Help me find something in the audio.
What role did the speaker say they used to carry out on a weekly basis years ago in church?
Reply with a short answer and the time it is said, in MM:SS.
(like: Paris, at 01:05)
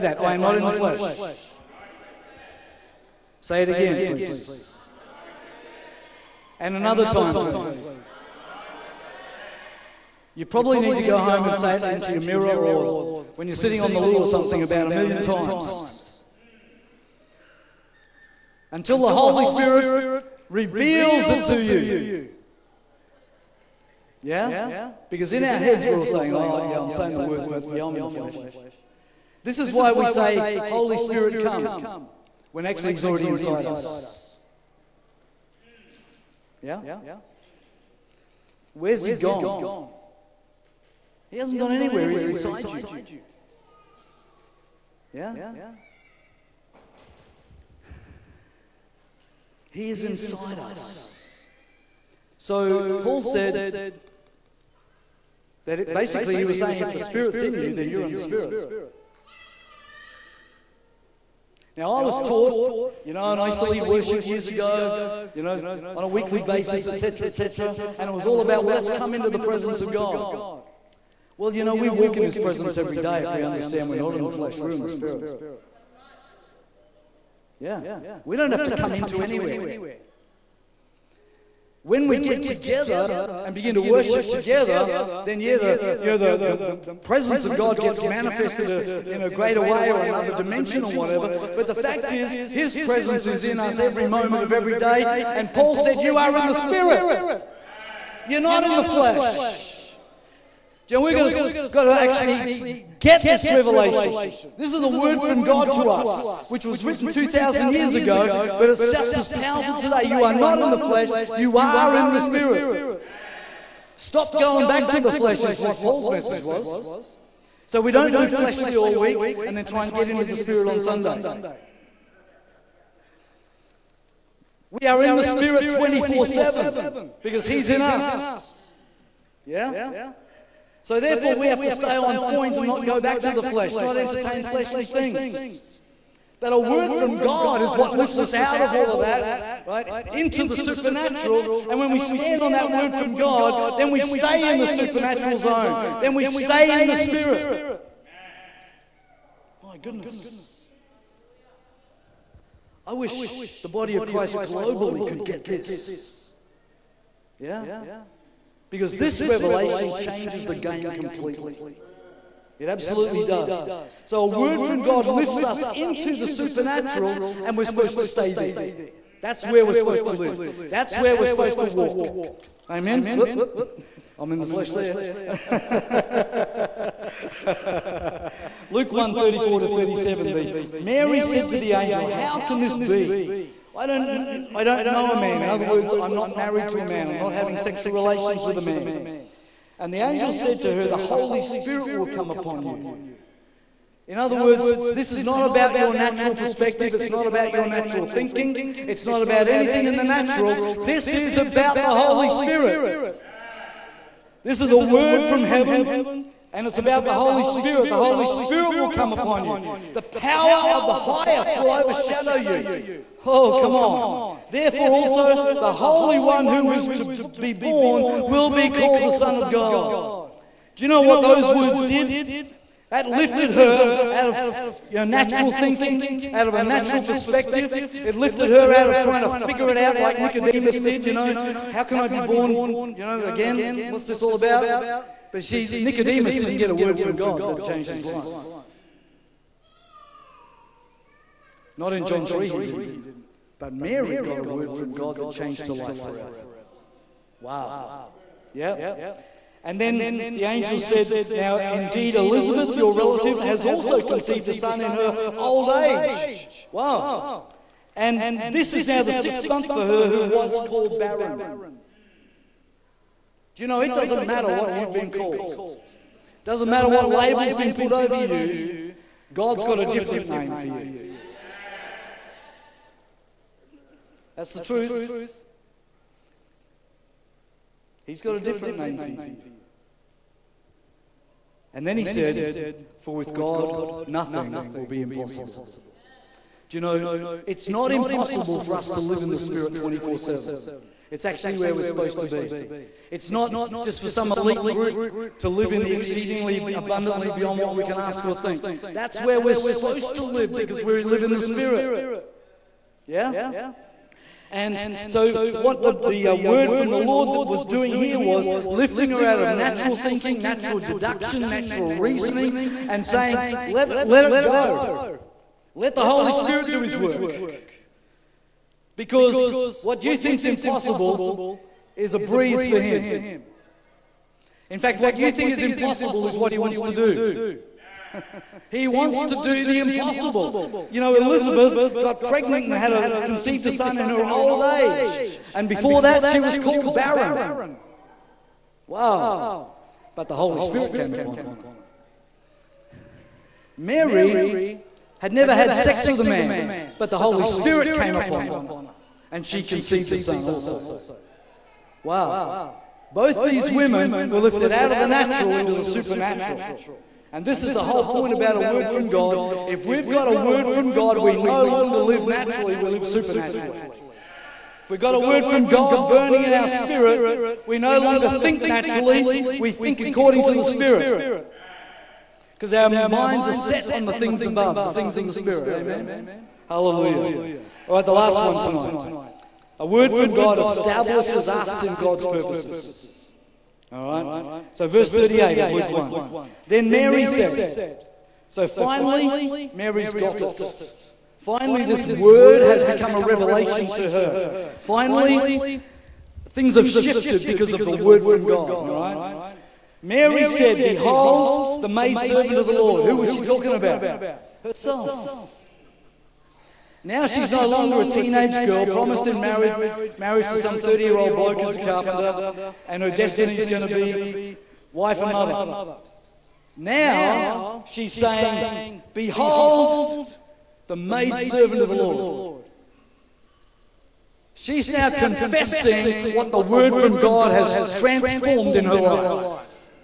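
Lead worship, at 01:03.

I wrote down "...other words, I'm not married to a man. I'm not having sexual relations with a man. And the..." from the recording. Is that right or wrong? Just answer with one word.
right.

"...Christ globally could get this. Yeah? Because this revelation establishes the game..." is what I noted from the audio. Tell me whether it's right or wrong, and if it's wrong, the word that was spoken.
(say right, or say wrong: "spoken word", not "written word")
wrong: "changes", not "establishes".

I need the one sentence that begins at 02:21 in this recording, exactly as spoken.
And when we stand on that word from God, then we stay in the supernatural zone.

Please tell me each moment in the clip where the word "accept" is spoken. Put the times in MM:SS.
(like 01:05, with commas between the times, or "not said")
not said.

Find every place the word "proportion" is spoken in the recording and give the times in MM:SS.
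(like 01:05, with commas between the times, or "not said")
not said.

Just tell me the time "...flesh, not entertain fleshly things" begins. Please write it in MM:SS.
02:13.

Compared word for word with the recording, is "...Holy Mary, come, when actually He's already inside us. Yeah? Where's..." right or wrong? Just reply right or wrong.
wrong.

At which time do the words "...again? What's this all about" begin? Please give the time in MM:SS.
03:53.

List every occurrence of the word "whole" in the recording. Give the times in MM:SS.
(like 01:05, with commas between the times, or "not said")
05:57.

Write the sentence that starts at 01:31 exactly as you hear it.
But the fact is, His presence is in us every moment of every day.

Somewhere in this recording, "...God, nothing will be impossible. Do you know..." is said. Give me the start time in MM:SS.
04:43.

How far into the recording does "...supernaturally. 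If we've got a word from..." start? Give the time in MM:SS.
06:03.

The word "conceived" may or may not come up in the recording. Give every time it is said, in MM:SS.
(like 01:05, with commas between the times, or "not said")
04:14, 05:33, 05:49.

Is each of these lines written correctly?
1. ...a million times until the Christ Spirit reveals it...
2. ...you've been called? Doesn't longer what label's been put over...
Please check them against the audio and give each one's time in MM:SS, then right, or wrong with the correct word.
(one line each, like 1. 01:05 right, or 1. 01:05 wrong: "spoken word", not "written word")
1. 00:14 wrong: "Holy", not "Christ"
2. 04:24 wrong: "matter", not "longer".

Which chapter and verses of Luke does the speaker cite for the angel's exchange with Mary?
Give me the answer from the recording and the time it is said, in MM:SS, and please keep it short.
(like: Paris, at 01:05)
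Luke 1:34-37, at 02:58.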